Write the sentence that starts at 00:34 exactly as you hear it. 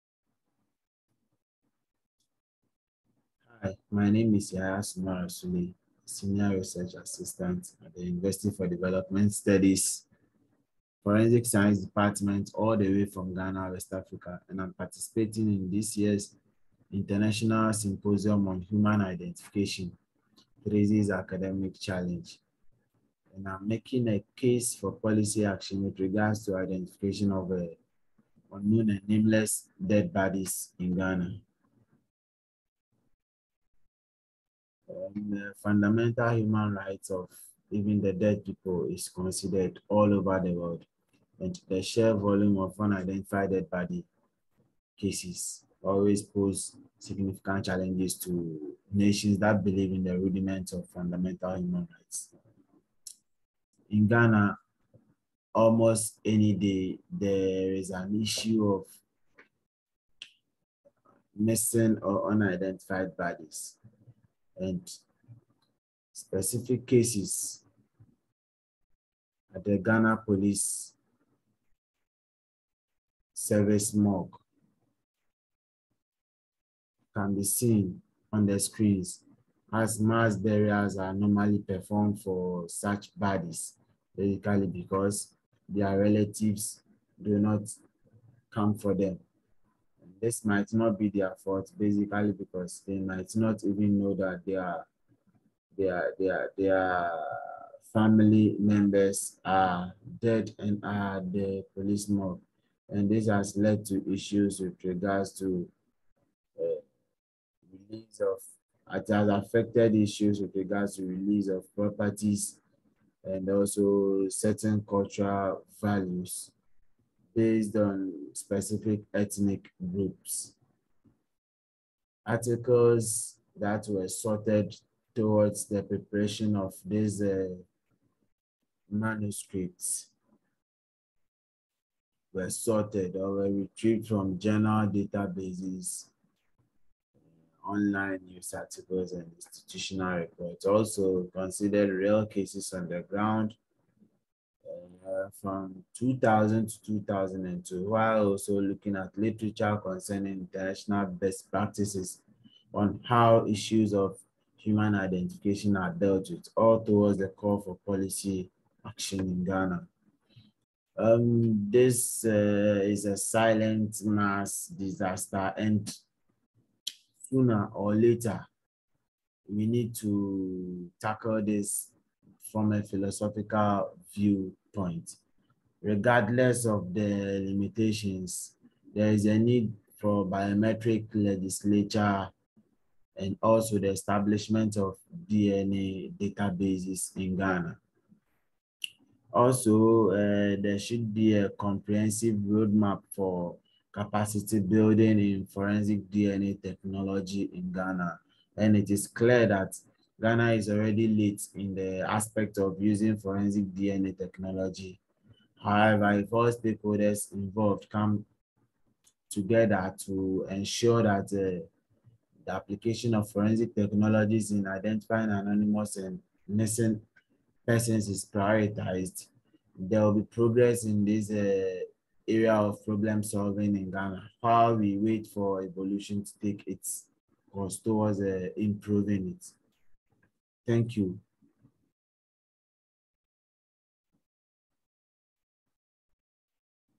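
um, fundamental human rights of even the dead people is considered all over the world.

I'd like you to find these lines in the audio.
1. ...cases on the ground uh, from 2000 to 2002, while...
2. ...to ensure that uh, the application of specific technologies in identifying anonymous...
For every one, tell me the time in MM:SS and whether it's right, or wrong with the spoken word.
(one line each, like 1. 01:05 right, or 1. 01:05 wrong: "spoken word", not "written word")
1. 02:22 right
2. 03:30 wrong: "forensic", not "specific".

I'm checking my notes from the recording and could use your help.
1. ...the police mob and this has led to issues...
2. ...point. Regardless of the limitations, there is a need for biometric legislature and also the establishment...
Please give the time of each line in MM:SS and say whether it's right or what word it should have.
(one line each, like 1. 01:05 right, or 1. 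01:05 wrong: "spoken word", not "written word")
1. 01:41 right
2. 02:54 right.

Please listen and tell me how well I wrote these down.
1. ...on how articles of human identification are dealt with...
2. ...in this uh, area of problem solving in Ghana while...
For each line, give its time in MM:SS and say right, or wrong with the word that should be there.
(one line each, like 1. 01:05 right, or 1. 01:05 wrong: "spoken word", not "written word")
1. 02:32 wrong: "issues", not "articles"
2. 03:40 right.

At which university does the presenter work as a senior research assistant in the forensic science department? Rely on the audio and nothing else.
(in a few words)
University for Development Studies.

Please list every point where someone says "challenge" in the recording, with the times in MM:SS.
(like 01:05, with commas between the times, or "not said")
00:21, 00:47.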